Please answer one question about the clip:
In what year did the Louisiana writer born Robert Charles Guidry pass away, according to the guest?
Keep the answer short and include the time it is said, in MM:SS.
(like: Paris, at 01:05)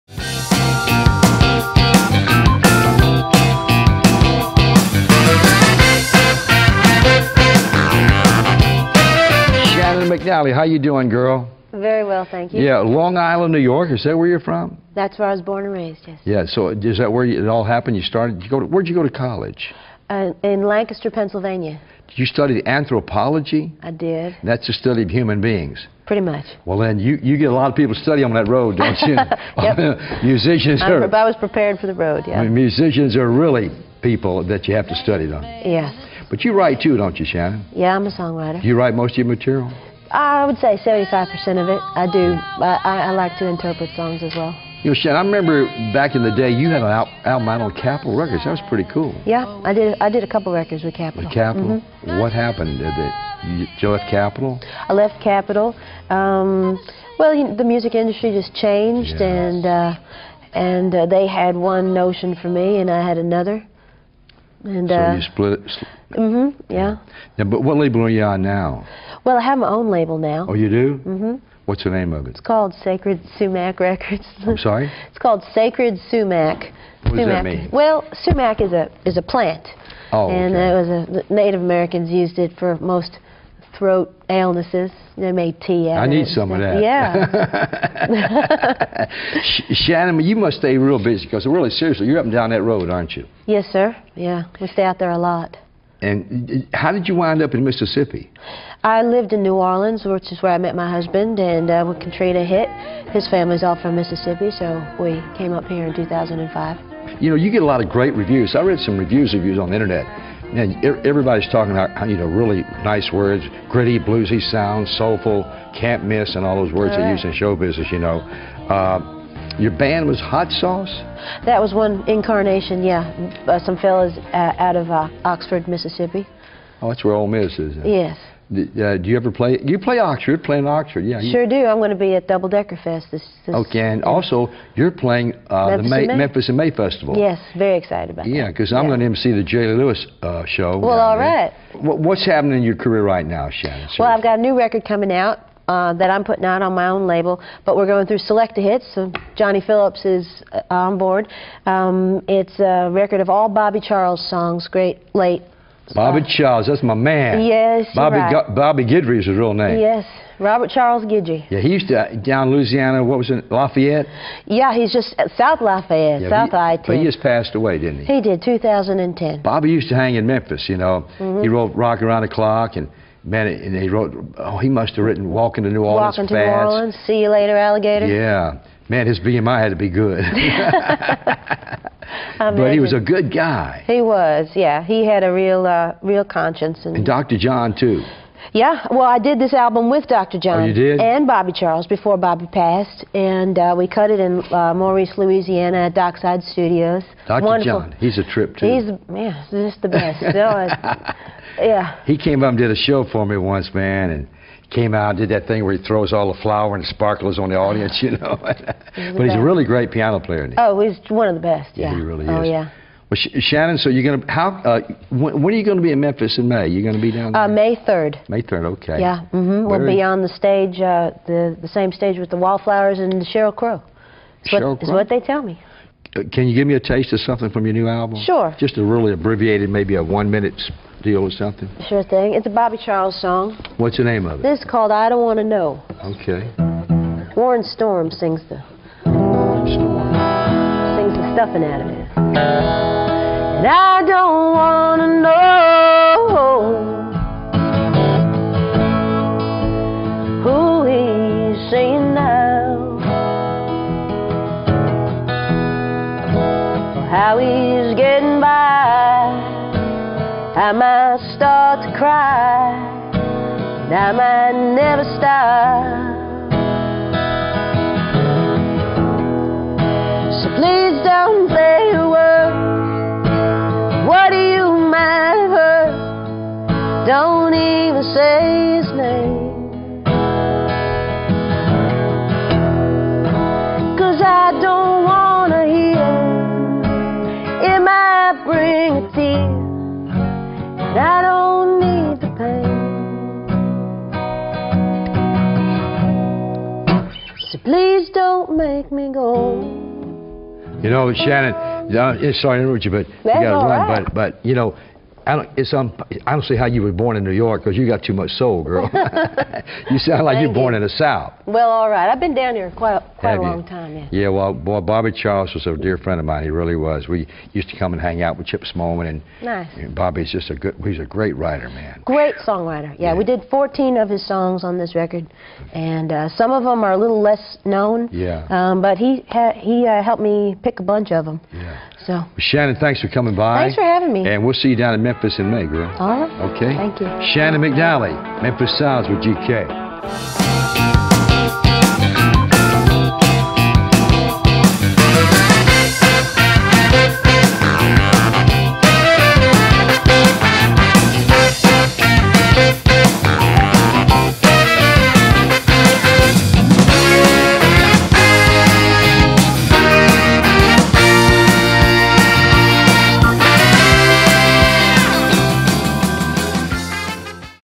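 2010, at 02:48.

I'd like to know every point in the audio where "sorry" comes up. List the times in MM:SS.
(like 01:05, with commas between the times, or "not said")
01:14, 05:02.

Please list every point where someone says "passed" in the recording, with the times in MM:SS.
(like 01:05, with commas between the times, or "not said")
02:47, 03:12.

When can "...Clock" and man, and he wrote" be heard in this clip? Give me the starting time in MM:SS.
02:52.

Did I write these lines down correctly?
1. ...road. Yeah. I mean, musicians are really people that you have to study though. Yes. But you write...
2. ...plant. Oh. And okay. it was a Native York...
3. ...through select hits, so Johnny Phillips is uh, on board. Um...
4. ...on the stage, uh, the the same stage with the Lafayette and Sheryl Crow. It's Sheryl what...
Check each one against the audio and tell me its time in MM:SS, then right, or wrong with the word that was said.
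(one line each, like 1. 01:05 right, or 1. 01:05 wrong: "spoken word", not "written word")
1. 00:31 right
2. 01:19 wrong: "Americans", not "York"
3. 02:28 right
4. 03:40 wrong: "Wallflowers", not "Lafayette".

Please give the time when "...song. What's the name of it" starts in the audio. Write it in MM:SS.
03:53.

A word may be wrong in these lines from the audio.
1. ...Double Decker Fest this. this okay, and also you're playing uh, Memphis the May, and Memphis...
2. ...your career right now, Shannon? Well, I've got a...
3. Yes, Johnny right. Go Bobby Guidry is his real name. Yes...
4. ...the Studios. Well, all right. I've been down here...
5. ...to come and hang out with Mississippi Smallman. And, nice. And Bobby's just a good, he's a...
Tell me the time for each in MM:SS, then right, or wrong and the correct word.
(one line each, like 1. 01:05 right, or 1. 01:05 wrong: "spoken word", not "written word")
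1. 02:12 right
2. 02:22 right
3. 02:37 wrong: "Bobby", not "Johnny"
4. 05:10 wrong: "South", not "Studios"
5. 05:17 wrong: "Chip", not "Mississippi".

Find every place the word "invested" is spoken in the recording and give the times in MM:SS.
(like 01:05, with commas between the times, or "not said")
not said.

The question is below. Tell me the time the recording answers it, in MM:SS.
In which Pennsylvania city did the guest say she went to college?
00:20.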